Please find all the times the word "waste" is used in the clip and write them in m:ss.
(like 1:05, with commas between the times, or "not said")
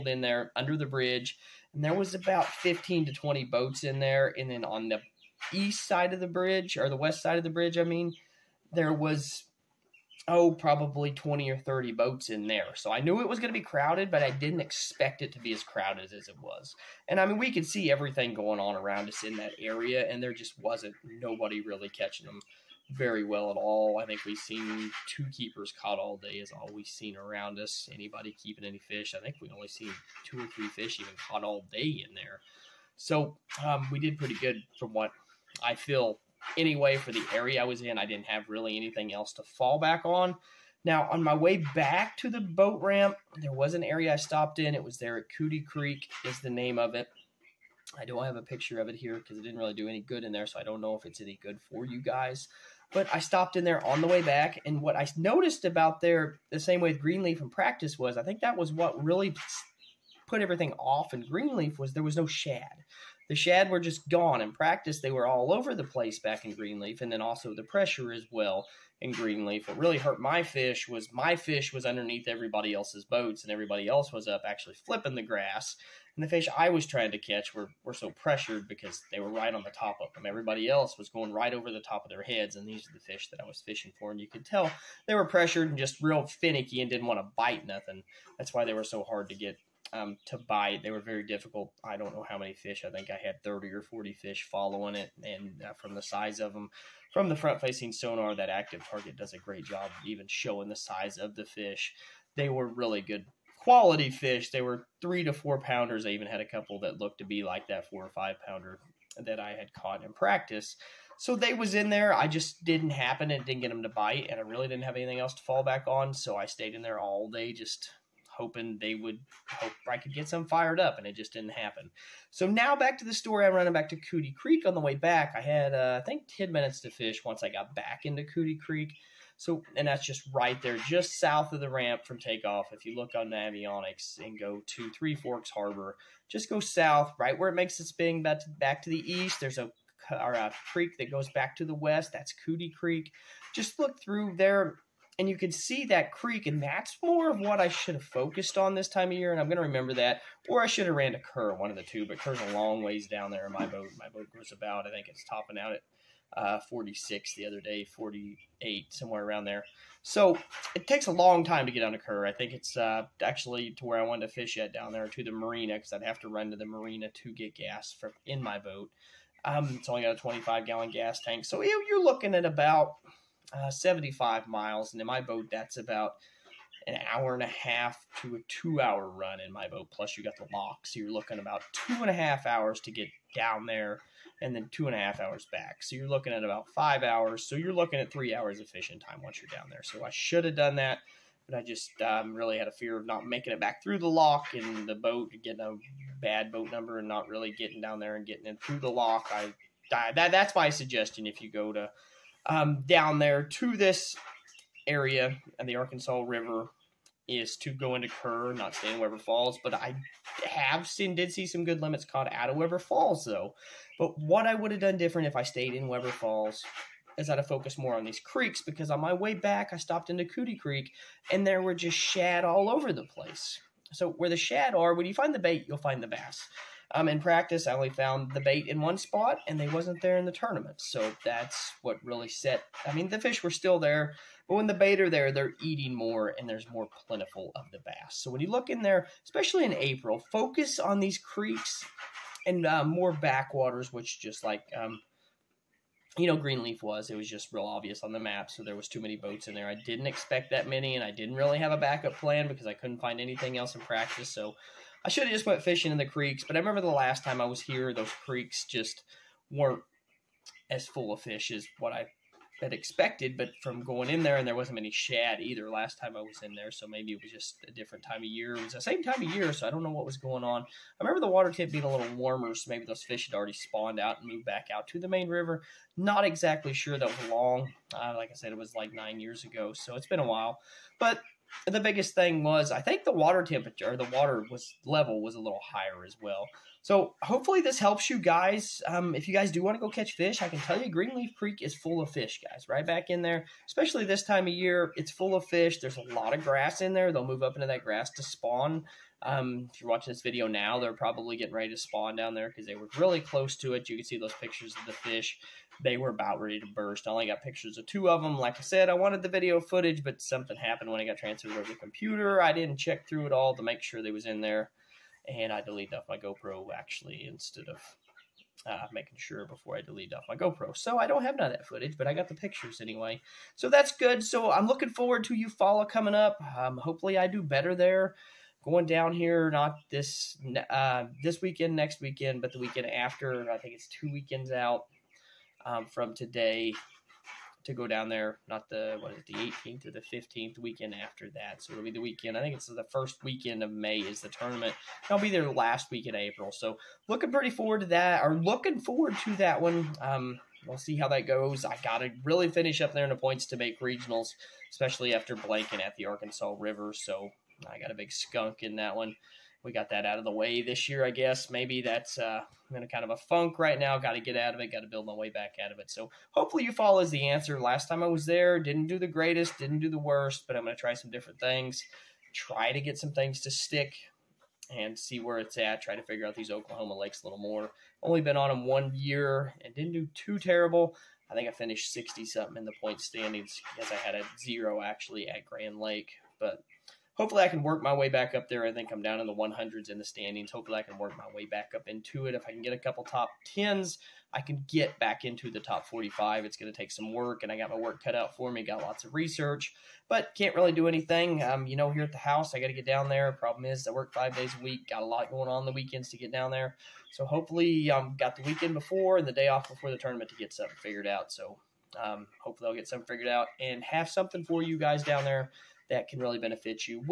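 not said.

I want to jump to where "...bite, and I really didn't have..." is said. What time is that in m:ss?
1:53.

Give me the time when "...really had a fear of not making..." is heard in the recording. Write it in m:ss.
3:12.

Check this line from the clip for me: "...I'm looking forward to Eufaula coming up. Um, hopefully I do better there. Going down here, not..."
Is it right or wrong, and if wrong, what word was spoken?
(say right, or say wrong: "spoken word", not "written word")
right.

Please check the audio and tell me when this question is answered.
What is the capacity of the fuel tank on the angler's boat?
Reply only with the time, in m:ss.
2:50.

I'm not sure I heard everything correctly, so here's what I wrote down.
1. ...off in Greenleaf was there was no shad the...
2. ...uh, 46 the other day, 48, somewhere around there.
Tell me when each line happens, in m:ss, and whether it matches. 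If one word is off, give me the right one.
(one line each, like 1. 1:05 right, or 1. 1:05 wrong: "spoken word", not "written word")
1. 1:00 right
2. 2:36 right.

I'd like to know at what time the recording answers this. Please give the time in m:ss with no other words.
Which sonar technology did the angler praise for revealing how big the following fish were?
1:38.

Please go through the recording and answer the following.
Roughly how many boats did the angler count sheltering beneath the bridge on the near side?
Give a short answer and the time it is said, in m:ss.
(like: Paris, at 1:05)
15 to 20, at 0:02.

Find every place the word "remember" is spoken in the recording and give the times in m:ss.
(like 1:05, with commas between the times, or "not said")
2:29, 4:16, 4:31.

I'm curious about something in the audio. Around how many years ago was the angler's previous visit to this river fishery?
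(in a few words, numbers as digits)
9 years.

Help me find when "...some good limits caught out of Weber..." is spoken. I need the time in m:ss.
3:31.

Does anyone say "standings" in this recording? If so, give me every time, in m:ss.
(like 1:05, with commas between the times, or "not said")
6:23, 6:30.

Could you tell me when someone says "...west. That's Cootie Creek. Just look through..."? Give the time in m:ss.
2:21.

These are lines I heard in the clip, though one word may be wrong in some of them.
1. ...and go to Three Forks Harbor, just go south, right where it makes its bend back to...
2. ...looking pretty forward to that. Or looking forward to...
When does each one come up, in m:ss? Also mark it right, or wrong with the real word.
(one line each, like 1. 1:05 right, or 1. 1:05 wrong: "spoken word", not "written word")
1. 2:14 right
2. 5:47 right.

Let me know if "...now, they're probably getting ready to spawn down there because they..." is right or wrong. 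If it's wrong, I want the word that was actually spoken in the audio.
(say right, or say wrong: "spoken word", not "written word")
right.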